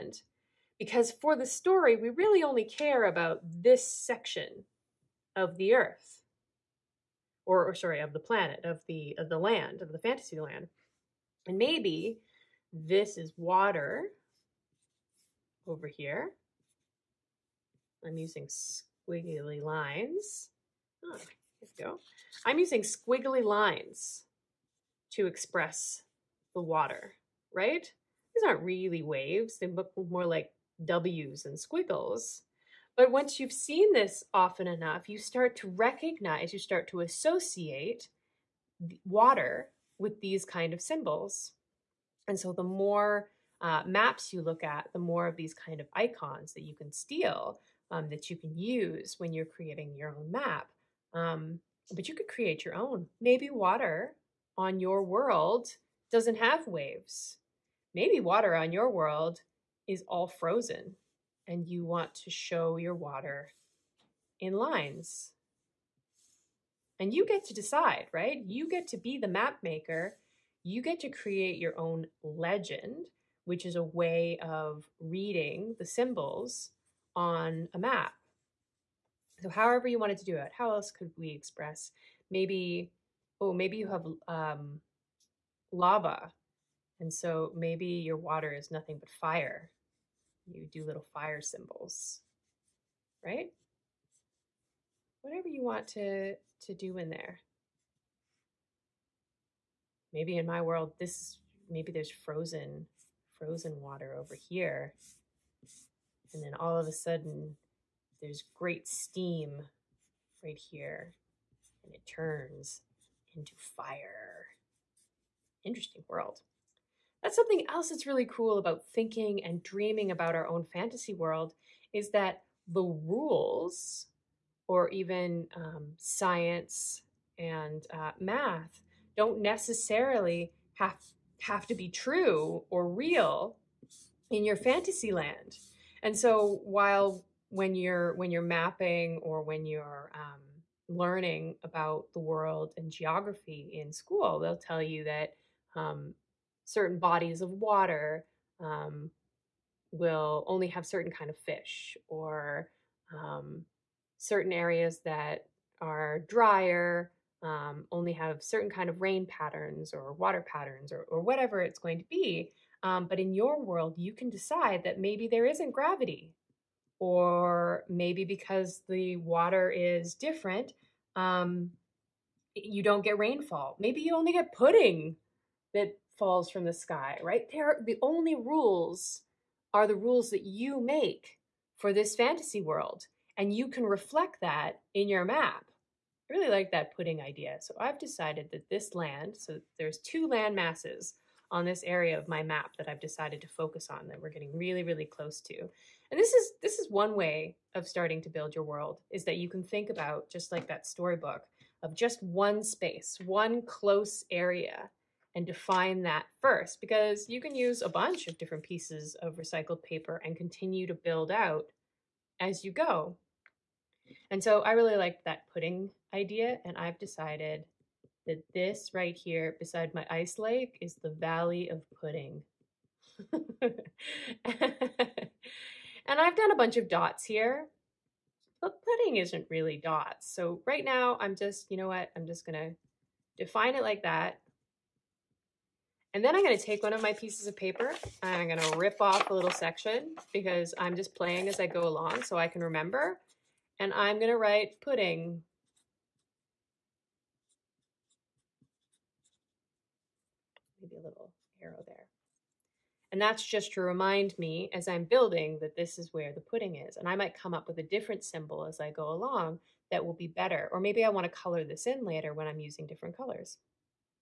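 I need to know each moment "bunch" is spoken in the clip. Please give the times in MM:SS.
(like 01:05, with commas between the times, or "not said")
03:27, 03:46.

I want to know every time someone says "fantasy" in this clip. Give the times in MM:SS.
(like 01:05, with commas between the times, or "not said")
00:09, 02:00, 02:14, 03:02.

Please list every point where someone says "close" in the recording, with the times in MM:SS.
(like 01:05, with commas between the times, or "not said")
03:15, 03:23.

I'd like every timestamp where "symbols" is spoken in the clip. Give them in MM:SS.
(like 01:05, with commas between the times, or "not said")
00:40, 01:15, 01:31, 04:18.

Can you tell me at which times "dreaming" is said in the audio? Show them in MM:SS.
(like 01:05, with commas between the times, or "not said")
01:59.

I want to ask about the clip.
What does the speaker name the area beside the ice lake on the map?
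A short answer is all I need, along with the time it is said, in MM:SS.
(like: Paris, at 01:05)
Valley of Pudding, at 03:41.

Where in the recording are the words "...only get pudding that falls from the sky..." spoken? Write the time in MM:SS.
02:54.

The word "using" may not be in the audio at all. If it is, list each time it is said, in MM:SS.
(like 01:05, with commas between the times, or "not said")
00:18, 00:22, 04:22.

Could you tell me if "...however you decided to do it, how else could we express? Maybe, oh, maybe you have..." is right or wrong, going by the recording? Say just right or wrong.
wrong.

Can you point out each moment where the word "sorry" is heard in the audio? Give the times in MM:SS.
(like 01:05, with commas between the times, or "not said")
00:07.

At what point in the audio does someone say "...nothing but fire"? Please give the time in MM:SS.
01:28.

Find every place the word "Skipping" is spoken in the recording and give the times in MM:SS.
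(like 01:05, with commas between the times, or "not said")
not said.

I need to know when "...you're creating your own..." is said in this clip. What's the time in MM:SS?
00:49.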